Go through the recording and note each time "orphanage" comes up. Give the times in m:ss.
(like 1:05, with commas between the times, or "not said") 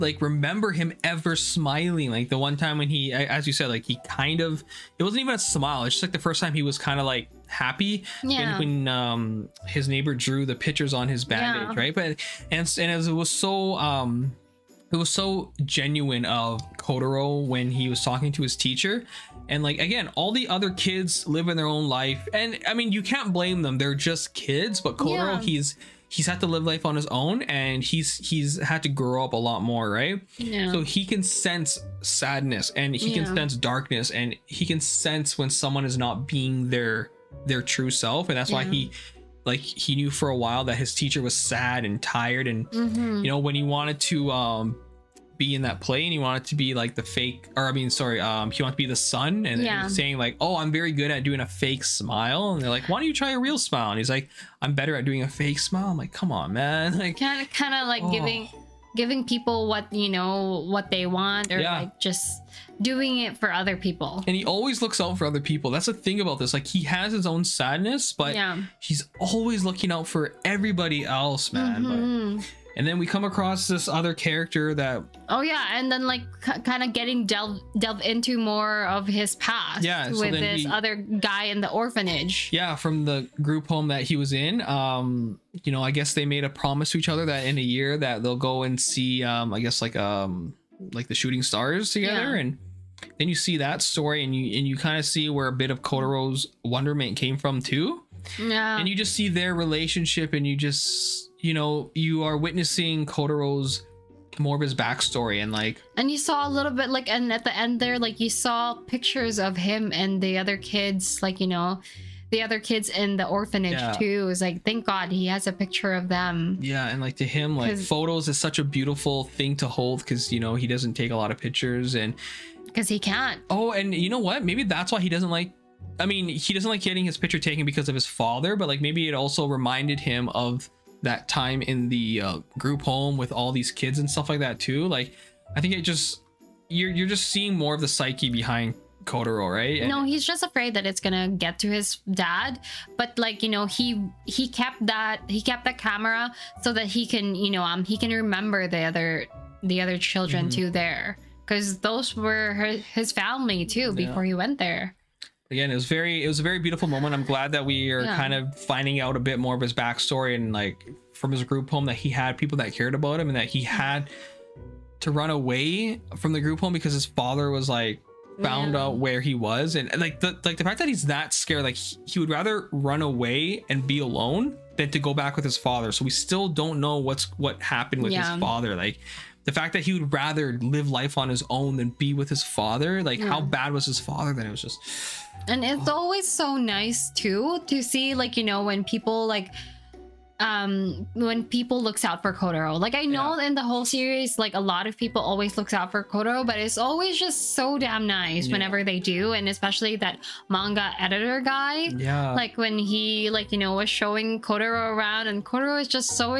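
1:21, 1:53.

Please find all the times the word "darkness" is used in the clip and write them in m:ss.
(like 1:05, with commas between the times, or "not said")
0:33.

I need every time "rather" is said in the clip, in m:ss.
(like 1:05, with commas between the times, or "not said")
2:52, 3:00.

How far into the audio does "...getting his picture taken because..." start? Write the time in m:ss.
2:06.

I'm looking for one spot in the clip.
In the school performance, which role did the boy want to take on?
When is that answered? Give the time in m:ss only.
0:48.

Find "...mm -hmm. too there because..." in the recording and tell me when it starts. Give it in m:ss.
2:30.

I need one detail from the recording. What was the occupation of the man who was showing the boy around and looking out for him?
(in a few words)
Manga editor.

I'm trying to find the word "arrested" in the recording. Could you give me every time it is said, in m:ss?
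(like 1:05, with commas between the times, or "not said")
not said.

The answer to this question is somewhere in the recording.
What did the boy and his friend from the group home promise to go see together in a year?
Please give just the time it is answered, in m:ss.
1:31.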